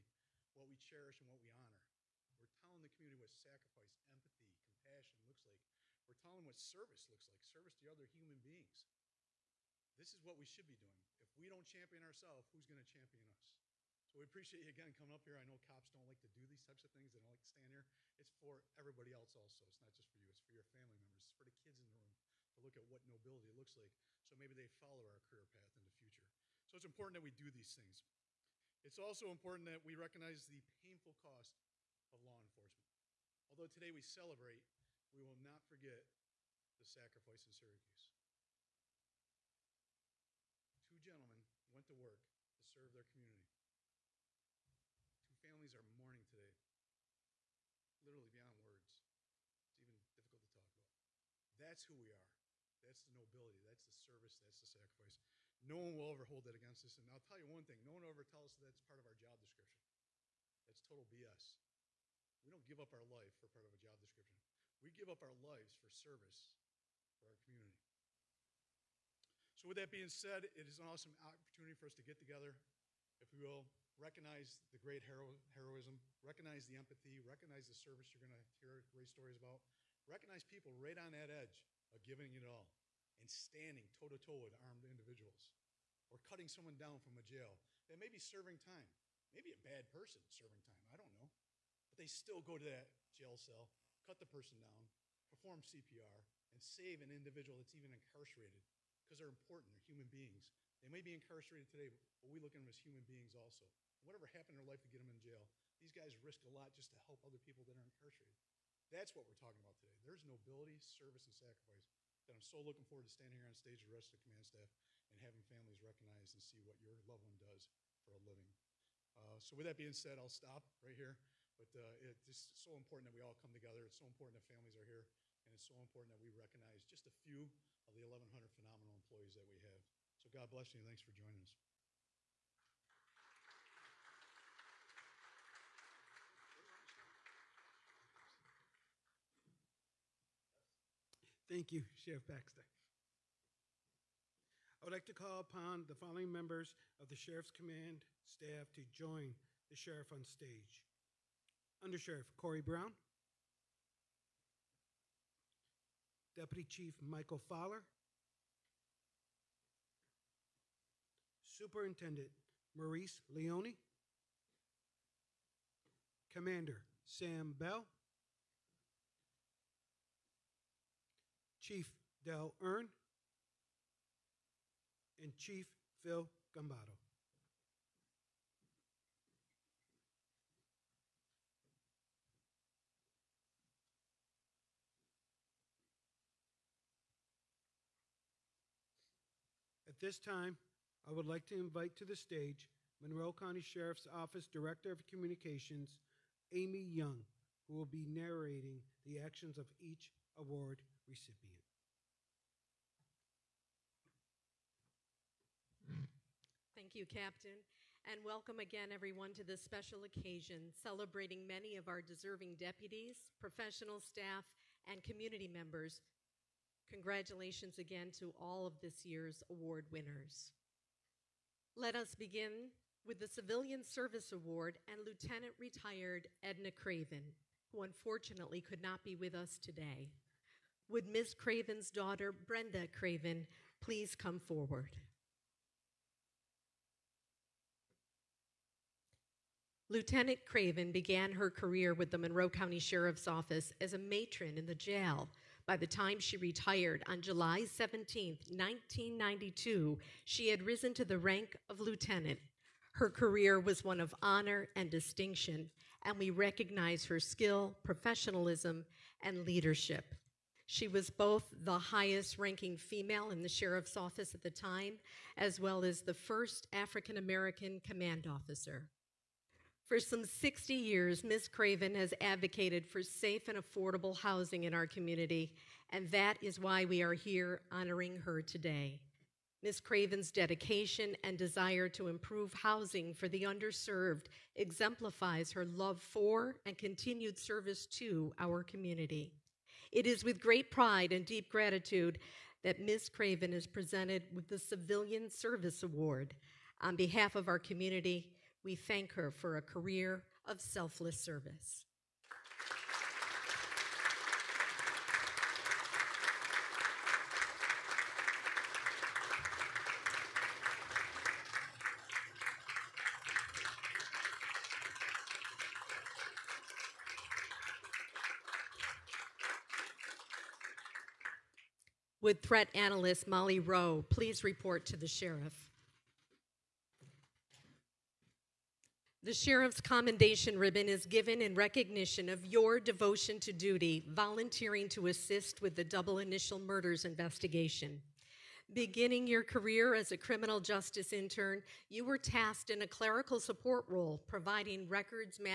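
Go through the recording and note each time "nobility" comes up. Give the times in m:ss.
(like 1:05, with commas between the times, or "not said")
0:23, 0:53, 1:50.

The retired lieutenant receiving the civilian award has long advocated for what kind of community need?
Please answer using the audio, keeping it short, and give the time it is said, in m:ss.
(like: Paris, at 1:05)
safe and affordable housing, at 4:33.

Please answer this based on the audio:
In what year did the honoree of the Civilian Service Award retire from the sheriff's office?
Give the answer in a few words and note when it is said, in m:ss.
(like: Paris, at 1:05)
1992, at 4:08.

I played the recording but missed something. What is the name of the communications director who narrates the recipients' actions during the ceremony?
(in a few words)
Amy Young.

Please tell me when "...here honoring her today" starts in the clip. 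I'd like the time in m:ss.
4:37.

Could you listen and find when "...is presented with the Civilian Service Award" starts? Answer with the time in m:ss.
4:53.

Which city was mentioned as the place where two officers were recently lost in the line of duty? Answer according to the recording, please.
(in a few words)
Syracuse.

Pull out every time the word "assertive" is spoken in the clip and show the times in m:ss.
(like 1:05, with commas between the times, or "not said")
not said.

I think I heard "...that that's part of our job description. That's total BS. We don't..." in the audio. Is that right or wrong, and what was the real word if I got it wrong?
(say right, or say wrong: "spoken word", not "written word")
right.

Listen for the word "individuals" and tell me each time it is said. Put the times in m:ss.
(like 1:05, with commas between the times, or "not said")
1:24, 1:37.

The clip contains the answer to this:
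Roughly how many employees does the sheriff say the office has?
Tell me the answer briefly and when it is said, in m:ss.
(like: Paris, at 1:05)
1,100, at 2:08.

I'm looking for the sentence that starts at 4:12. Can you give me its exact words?
Her career was one of honor and distinction, and we recognize her skill, professionalism, and leadership.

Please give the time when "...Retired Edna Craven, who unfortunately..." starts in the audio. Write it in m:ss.
3:45.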